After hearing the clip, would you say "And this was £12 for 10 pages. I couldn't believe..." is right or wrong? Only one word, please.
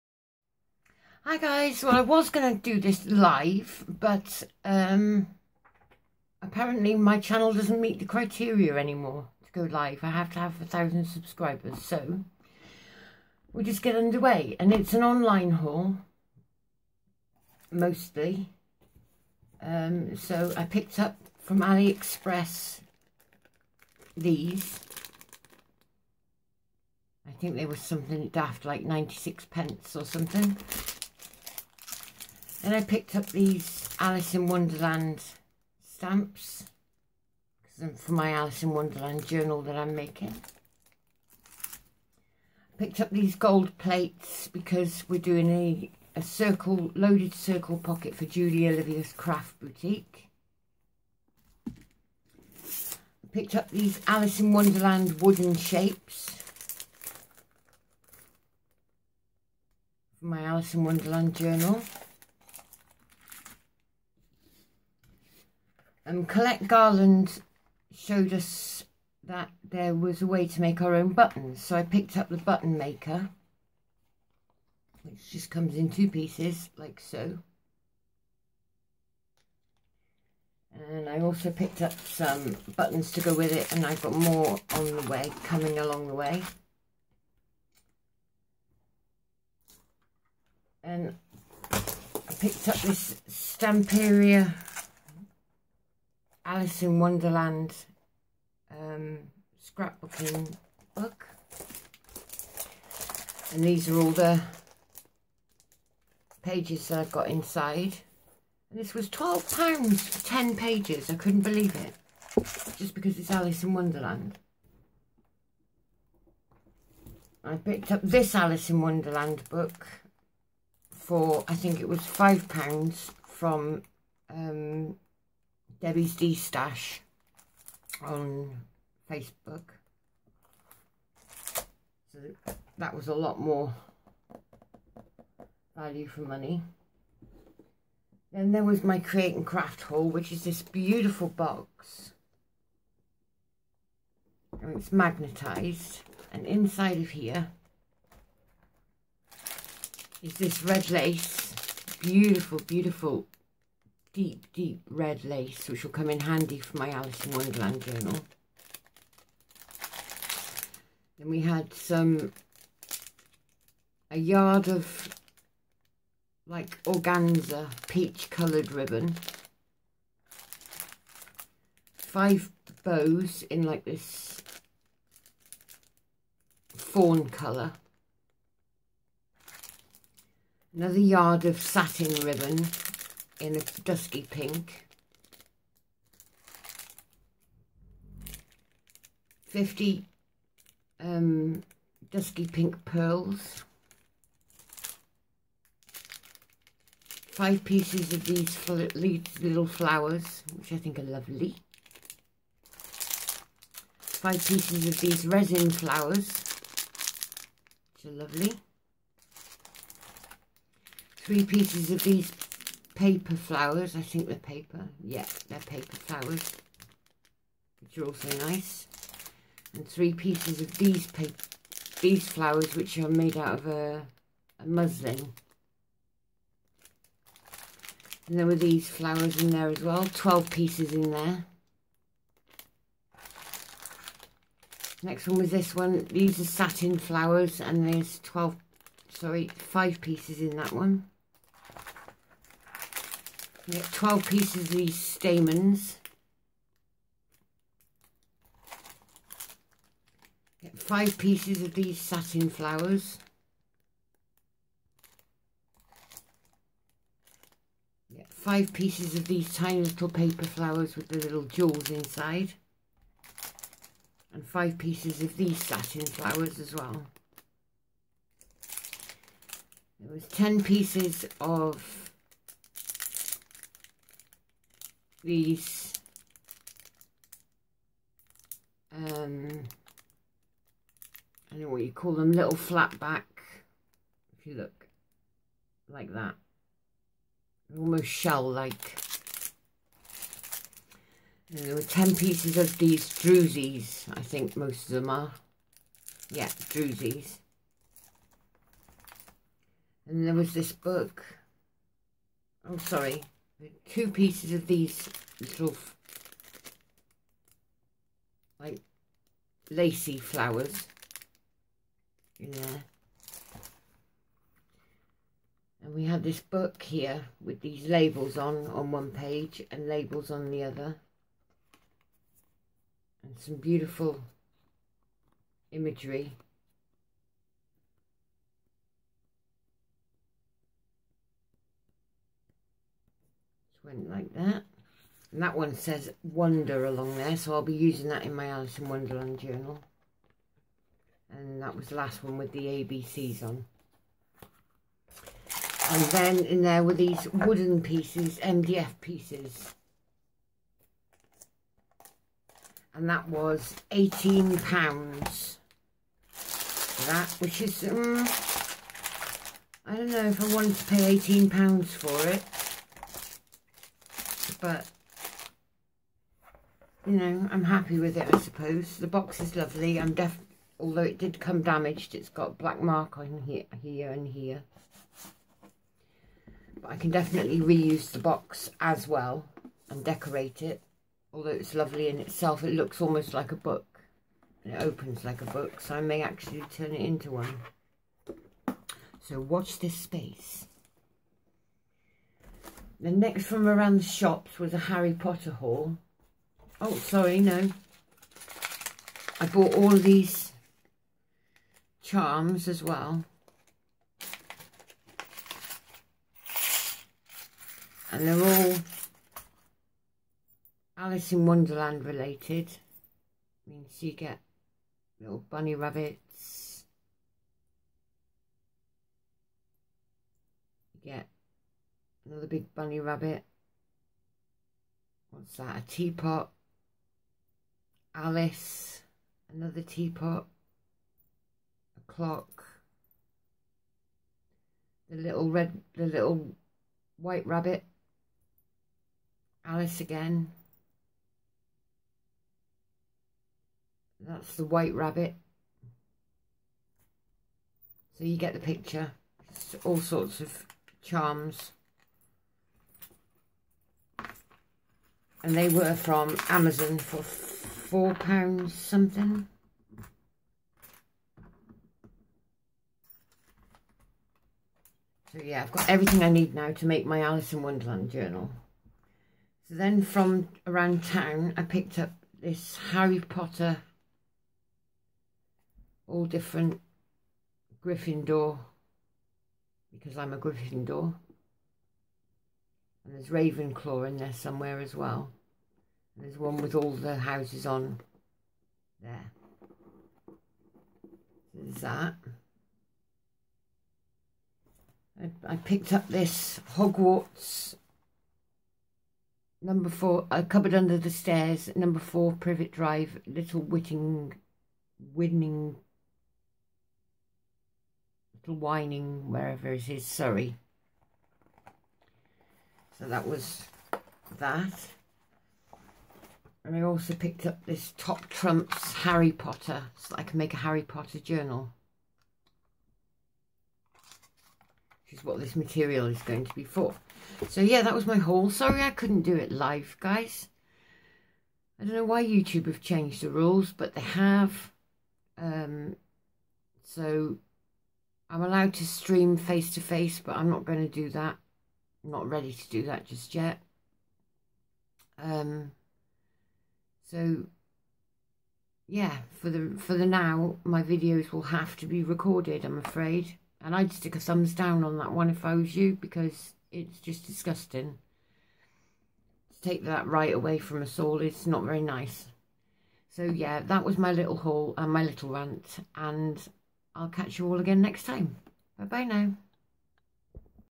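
right.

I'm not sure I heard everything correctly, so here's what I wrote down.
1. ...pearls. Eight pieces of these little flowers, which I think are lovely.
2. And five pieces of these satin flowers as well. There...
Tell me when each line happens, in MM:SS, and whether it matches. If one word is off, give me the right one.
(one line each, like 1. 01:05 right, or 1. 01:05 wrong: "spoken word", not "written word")
1. 03:12 wrong: "Five", not "Eight"
2. 04:24 right.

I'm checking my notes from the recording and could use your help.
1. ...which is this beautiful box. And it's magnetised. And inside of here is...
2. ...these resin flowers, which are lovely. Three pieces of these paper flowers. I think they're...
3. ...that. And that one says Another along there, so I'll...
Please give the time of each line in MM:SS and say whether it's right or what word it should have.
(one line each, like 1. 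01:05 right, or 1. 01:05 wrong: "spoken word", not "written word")
1. 02:20 right
2. 03:25 right
3. 05:34 wrong: "Wonder", not "Another".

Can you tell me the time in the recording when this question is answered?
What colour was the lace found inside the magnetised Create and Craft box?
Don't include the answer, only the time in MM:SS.
02:34.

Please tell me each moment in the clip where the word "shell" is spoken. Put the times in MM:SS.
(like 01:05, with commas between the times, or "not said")
04:48.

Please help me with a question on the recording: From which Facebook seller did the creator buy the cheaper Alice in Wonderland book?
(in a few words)
Debbie's D Stash.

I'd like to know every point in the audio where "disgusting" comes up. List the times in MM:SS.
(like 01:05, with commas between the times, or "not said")
09:17.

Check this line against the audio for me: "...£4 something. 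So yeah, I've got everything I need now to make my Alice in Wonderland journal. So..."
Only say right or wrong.
right.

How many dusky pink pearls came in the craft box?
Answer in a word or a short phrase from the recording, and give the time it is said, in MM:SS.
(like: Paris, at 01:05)
50, at 03:09.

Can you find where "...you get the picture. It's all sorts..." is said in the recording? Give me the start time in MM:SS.
07:28.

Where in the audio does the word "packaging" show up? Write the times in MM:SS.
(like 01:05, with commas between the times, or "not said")
not said.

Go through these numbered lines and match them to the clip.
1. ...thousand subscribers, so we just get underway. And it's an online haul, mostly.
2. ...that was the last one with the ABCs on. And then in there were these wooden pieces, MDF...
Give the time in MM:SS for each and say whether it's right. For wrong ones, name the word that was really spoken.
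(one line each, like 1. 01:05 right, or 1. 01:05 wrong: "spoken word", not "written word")
1. 00:10 right
2. 05:41 right.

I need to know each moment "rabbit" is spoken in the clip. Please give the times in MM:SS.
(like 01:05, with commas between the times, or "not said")
06:55, 07:02, 07:17, 07:24.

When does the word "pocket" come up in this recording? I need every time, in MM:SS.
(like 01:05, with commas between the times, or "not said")
00:47.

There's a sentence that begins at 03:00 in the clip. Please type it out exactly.
Another yard of satin ribbon in a dusky pink.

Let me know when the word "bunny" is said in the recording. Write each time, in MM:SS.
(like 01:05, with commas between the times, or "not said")
06:55, 07:02.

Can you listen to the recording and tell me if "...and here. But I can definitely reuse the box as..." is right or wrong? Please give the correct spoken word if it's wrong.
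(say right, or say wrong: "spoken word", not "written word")
right.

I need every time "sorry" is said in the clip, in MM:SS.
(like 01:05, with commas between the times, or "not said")
03:59, 05:02, 06:36, 08:30, 08:48.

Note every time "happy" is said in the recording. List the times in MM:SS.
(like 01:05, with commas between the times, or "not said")
06:07.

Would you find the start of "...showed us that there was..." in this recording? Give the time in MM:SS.
01:07.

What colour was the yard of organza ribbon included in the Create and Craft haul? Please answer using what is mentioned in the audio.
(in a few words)
Peach.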